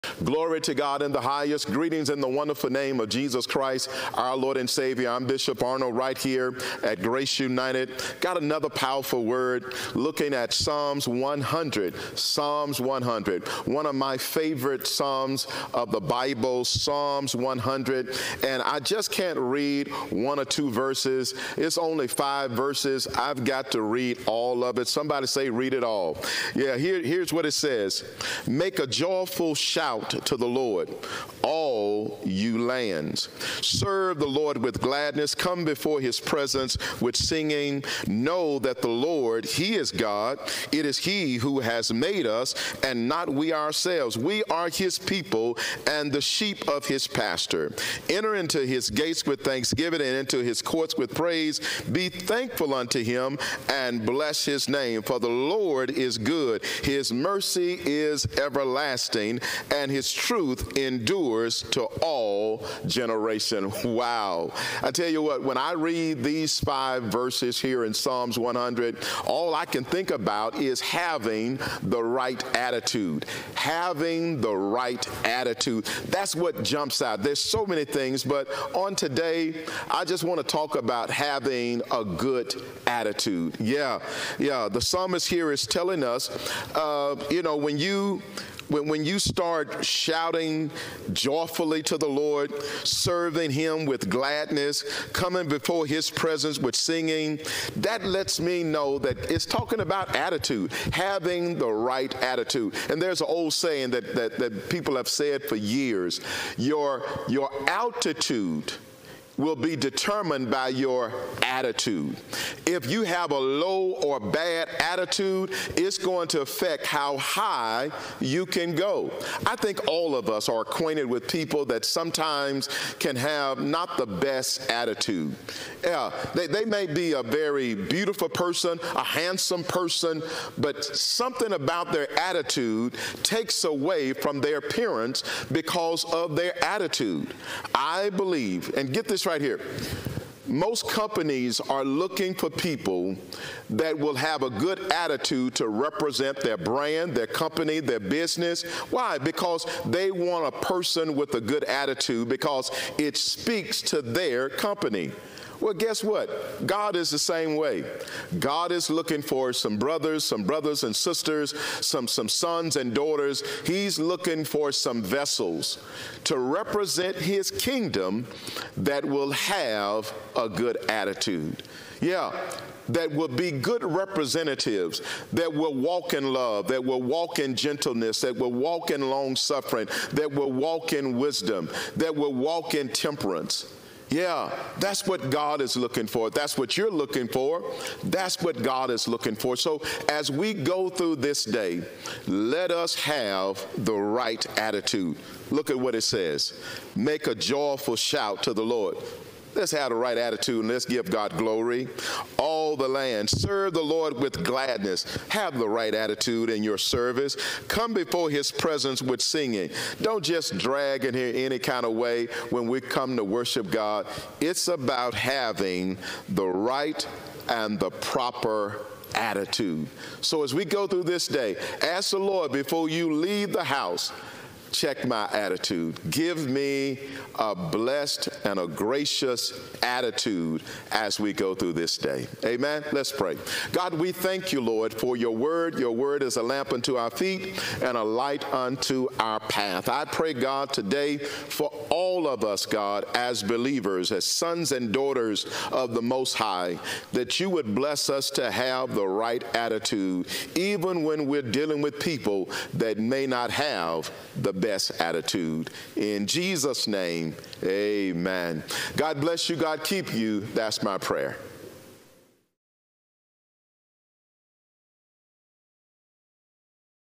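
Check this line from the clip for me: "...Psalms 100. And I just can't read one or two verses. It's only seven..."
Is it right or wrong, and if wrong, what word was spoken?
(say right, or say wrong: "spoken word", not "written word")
wrong: "five", not "seven".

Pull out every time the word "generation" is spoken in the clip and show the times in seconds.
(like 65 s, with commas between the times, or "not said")
62 s.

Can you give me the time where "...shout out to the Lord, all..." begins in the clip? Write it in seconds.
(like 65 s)
29 s.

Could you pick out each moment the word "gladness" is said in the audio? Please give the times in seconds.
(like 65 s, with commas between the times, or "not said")
34 s, 94 s, 204 s.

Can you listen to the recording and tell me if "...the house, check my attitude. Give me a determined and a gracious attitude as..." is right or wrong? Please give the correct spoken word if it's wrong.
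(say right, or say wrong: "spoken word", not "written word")
wrong: "blessed", not "determined".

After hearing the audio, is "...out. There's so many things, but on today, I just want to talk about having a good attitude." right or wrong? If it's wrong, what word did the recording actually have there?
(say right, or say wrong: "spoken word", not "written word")
right.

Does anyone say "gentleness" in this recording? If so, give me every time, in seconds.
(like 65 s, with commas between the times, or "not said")
177 s.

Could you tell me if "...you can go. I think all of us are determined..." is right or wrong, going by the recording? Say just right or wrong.
wrong.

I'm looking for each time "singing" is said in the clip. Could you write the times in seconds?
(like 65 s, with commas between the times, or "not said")
37 s, 96 s, 209 s.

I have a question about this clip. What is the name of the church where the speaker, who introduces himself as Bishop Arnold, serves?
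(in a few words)
Grace United.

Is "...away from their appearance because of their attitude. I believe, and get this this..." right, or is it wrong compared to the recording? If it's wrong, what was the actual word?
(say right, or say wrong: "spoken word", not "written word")
right.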